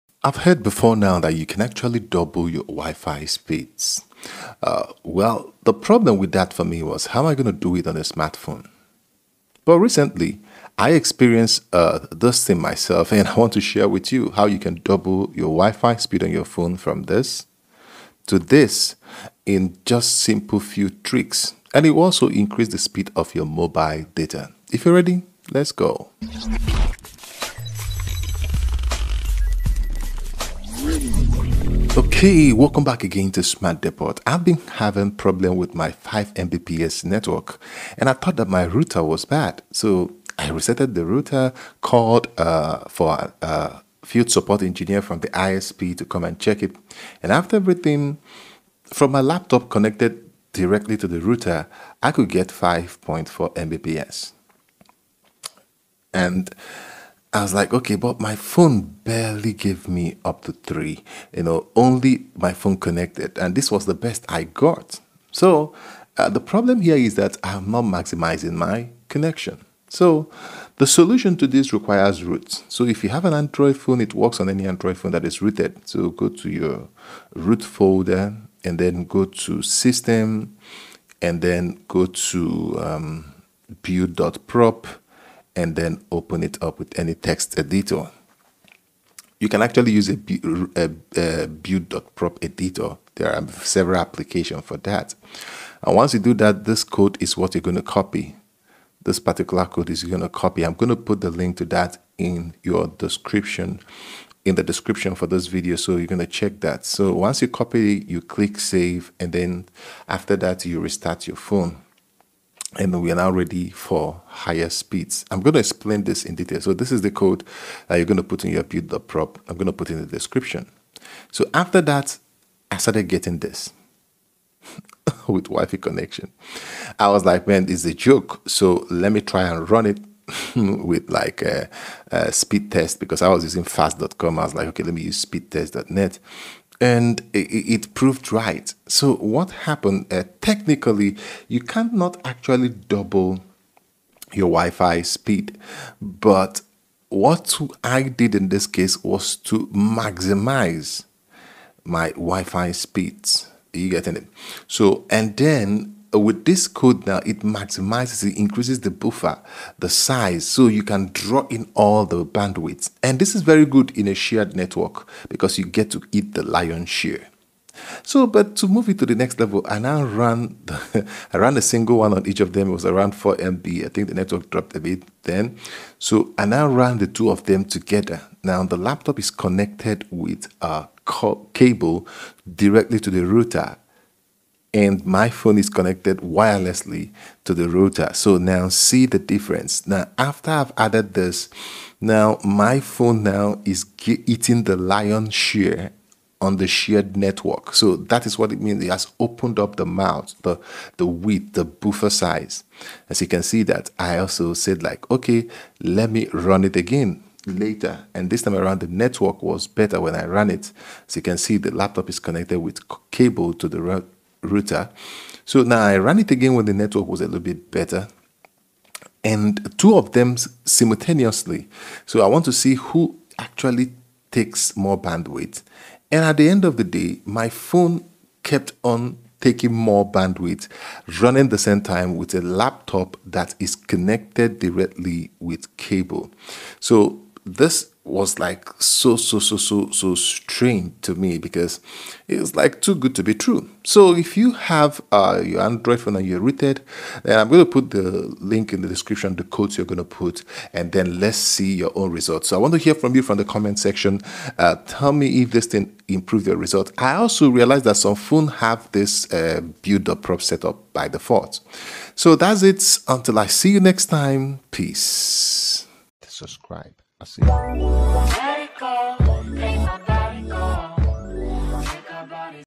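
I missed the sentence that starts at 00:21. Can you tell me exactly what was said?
And it will also increase the speed of your mobile data.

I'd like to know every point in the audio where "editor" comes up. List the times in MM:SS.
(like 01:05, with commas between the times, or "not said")
01:27, 01:32.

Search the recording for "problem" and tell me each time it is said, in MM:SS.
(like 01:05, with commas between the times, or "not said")
00:05, 00:35, 01:06.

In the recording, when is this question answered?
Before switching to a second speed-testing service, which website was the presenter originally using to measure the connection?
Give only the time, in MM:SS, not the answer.
02:13.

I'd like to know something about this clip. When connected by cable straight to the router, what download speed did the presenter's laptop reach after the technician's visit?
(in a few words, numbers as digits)
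5.4 Mbps.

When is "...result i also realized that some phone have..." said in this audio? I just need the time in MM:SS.
04:16.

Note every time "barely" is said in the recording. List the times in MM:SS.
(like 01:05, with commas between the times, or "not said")
00:58.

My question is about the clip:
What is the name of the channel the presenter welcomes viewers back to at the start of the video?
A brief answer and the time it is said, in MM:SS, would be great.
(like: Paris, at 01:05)
Smart Depot, at 00:33.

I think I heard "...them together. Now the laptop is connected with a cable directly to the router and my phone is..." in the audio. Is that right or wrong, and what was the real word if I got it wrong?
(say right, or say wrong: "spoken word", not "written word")
right.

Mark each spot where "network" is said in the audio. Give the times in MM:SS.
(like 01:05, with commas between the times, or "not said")
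00:37, 02:44, 02:54, 03:17, 03:28, 03:36.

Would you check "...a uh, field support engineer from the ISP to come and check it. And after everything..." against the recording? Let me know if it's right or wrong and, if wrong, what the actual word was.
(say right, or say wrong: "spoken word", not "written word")
right.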